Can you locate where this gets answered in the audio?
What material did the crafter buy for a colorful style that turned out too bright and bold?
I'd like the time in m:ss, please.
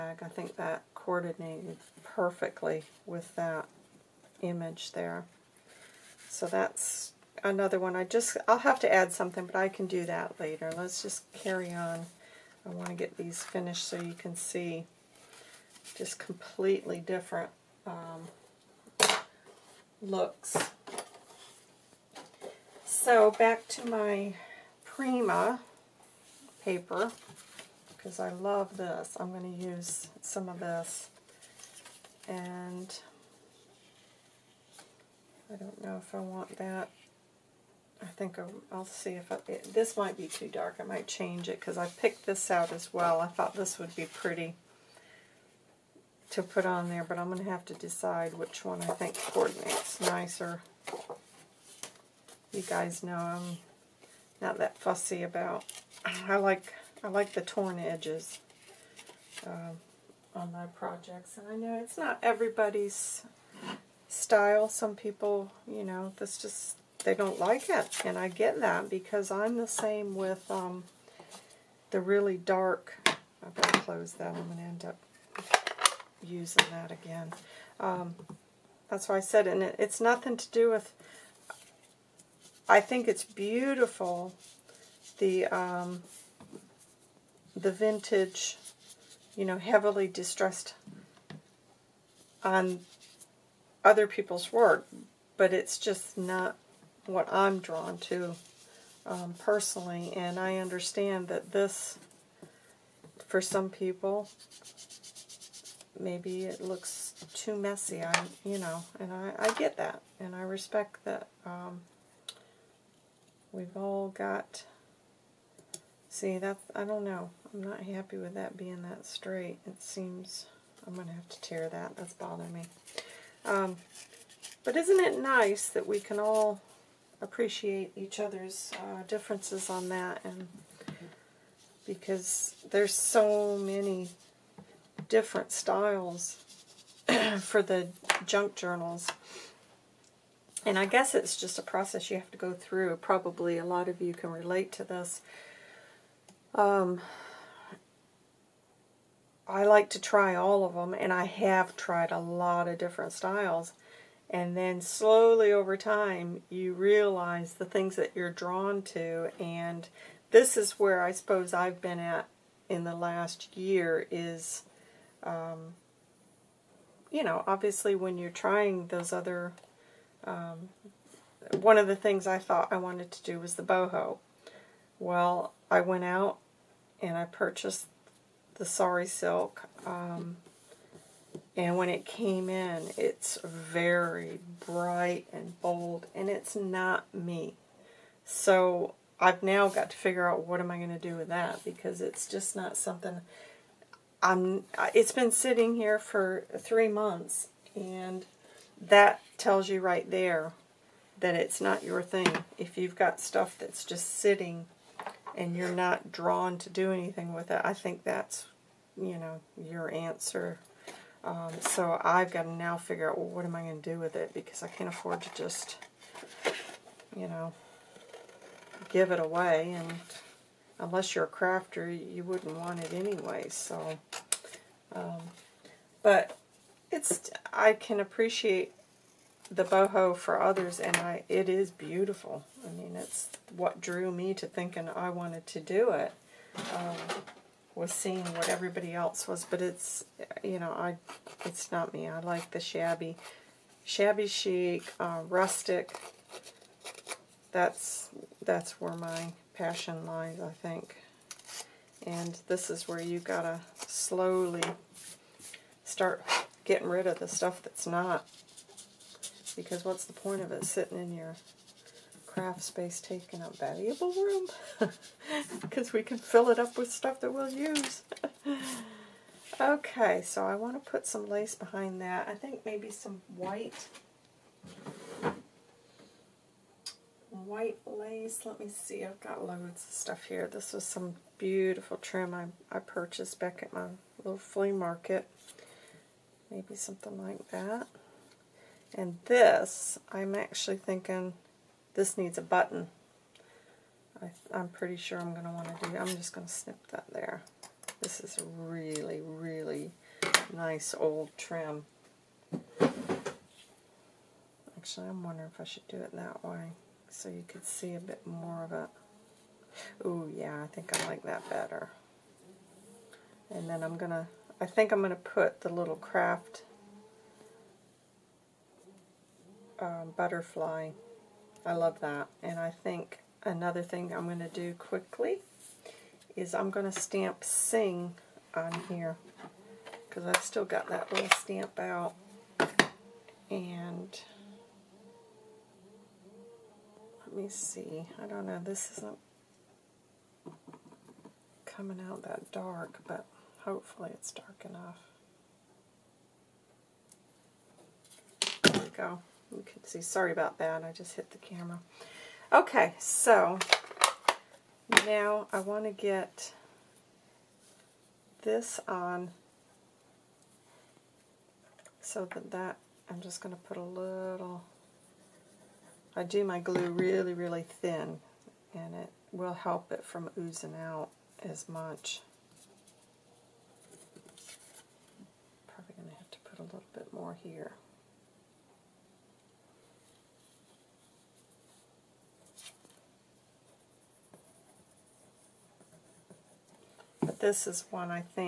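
2:58.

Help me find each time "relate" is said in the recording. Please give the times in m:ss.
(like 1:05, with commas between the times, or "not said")
2:24.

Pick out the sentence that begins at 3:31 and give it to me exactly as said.
Um, so I've got to now figure out, well, what am I going to do with it?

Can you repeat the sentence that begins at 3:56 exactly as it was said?
Um, was seeing what everybody else was, but it's you know I it's not me.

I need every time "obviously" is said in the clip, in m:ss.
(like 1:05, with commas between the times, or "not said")
2:47.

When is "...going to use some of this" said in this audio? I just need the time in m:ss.
0:29.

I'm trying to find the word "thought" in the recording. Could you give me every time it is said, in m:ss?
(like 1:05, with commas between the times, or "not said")
0:43, 2:52.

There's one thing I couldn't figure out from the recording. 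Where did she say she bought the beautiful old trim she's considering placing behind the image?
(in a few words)
flea market.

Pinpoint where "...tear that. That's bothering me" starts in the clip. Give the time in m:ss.
2:01.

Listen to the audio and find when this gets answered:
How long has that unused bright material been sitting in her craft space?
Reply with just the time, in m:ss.
3:16.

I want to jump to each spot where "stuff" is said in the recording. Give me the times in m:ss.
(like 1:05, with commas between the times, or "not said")
3:23, 4:17, 4:26, 4:39.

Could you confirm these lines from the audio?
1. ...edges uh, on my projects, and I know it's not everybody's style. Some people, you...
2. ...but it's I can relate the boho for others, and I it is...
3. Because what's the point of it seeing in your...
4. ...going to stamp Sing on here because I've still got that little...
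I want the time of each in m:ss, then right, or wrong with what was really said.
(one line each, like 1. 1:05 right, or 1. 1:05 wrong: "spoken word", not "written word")
1. 0:57 right
2. 3:46 wrong: "appreciate", not "relate"
3. 4:19 wrong: "sitting", not "seeing"
4. 5:26 right.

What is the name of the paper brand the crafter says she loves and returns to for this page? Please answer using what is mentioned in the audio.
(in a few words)
Prima.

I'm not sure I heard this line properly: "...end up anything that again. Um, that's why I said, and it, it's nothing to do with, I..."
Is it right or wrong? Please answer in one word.
wrong.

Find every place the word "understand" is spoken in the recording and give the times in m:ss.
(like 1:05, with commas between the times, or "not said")
1:40.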